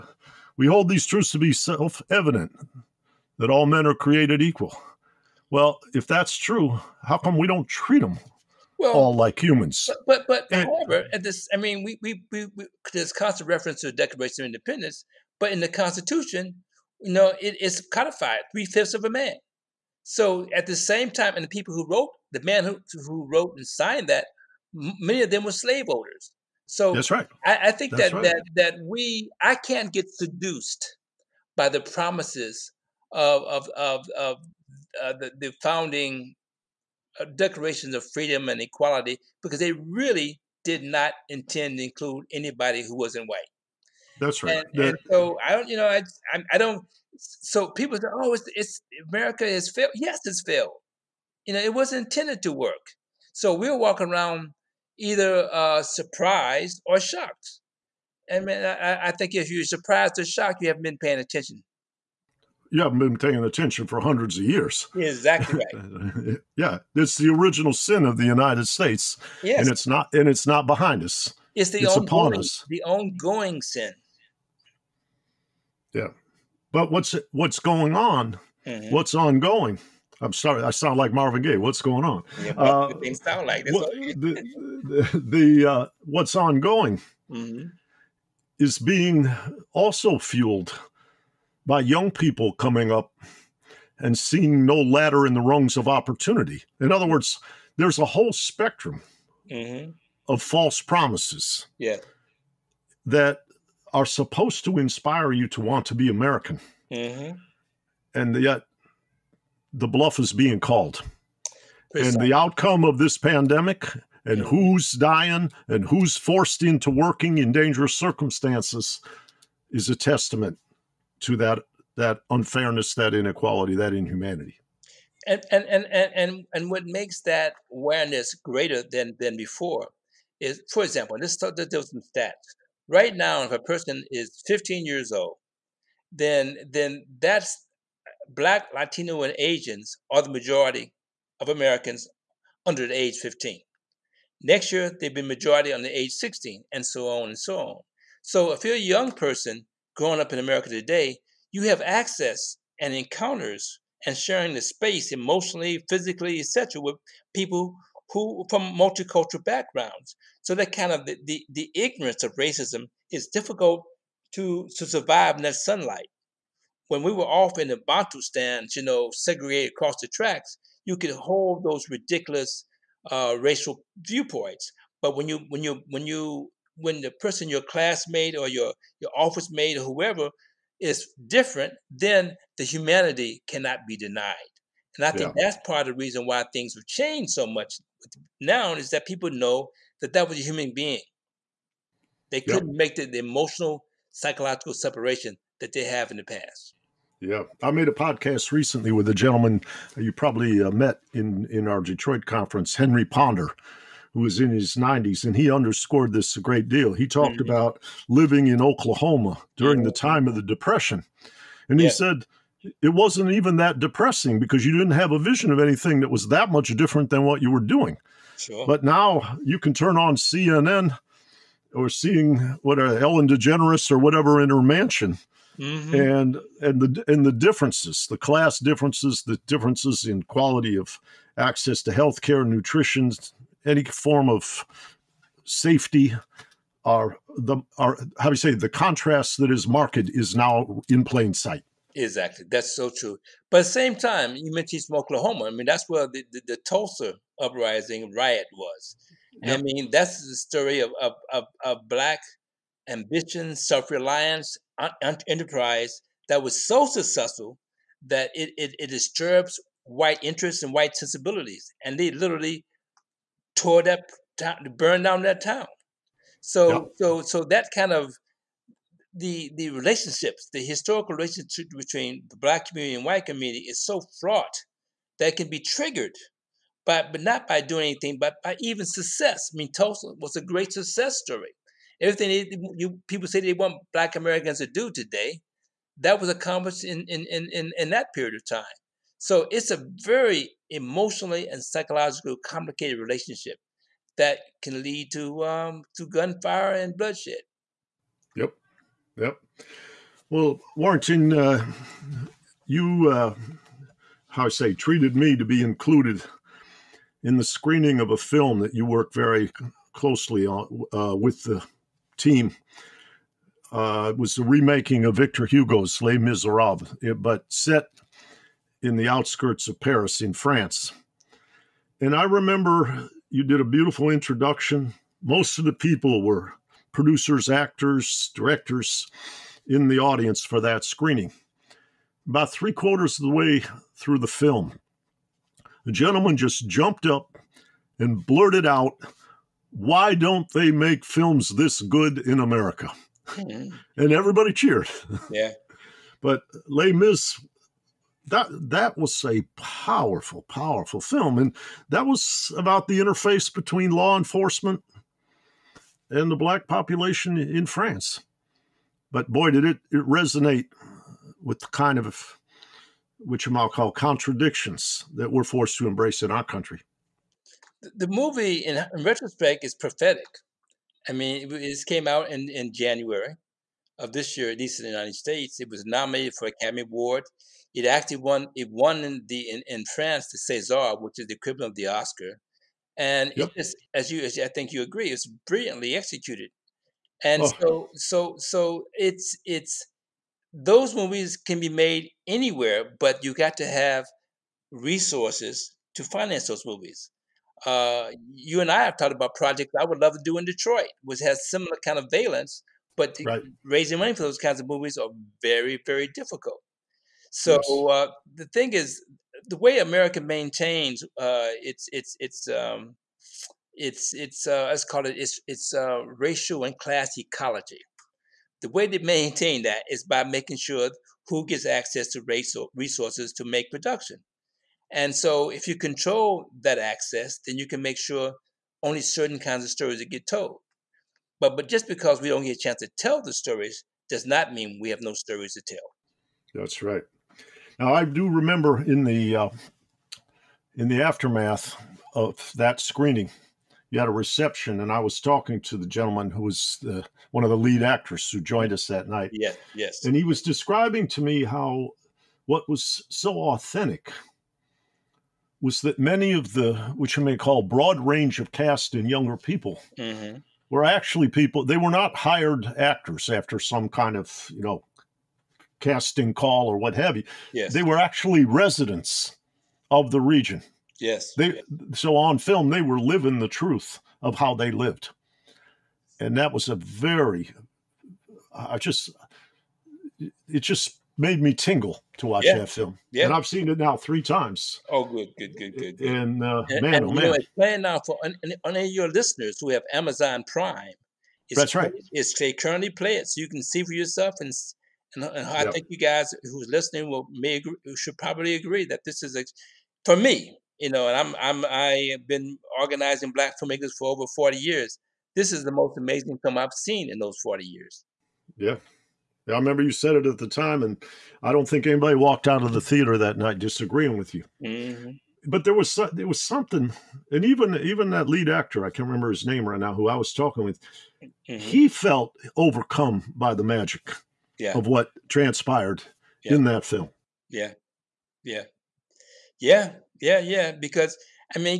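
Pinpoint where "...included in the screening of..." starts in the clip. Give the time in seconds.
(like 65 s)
305 s.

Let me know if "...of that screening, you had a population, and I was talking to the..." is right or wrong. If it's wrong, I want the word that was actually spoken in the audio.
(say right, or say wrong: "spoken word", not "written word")
wrong: "reception", not "population".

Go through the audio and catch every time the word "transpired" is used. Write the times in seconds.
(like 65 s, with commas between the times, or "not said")
525 s.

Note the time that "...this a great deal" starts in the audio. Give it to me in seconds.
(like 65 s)
206 s.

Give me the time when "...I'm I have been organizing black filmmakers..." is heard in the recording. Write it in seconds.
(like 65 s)
501 s.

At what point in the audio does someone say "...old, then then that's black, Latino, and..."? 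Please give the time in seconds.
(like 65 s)
135 s.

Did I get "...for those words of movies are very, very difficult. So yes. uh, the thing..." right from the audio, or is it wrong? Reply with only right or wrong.
wrong.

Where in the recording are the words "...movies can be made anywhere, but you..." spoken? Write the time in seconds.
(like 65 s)
390 s.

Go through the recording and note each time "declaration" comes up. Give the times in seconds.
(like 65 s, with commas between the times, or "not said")
13 s, 37 s.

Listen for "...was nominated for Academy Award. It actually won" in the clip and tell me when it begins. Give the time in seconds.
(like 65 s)
375 s.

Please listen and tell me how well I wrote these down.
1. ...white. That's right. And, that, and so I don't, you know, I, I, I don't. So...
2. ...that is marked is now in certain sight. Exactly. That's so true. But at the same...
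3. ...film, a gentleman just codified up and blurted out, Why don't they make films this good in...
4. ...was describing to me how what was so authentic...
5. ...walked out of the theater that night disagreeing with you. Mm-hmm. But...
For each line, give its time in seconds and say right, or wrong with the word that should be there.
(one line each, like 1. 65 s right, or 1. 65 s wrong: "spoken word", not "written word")
1. 43 s right
2. 239 s wrong: "plain", not "certain"
3. 334 s wrong: "jumped", not "codified"
4. 450 s right
5. 512 s right.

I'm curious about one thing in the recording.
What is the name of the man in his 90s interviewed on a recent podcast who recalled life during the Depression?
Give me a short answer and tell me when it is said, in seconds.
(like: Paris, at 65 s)
Henry Ponder, at 202 s.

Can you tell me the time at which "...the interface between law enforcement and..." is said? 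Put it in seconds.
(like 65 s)
352 s.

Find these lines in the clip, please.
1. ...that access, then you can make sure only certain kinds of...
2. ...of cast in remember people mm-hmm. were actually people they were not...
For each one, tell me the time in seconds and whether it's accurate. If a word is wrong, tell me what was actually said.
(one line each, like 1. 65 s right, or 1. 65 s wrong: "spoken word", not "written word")
1. 426 s right
2. 458 s wrong: "younger", not "remember".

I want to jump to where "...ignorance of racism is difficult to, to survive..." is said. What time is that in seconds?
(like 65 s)
161 s.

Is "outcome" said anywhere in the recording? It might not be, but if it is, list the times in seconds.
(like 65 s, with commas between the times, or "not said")
112 s.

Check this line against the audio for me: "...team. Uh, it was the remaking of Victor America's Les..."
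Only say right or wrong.
wrong.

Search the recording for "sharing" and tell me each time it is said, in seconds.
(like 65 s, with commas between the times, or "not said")
154 s.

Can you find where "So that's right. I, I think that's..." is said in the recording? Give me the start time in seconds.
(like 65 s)
26 s.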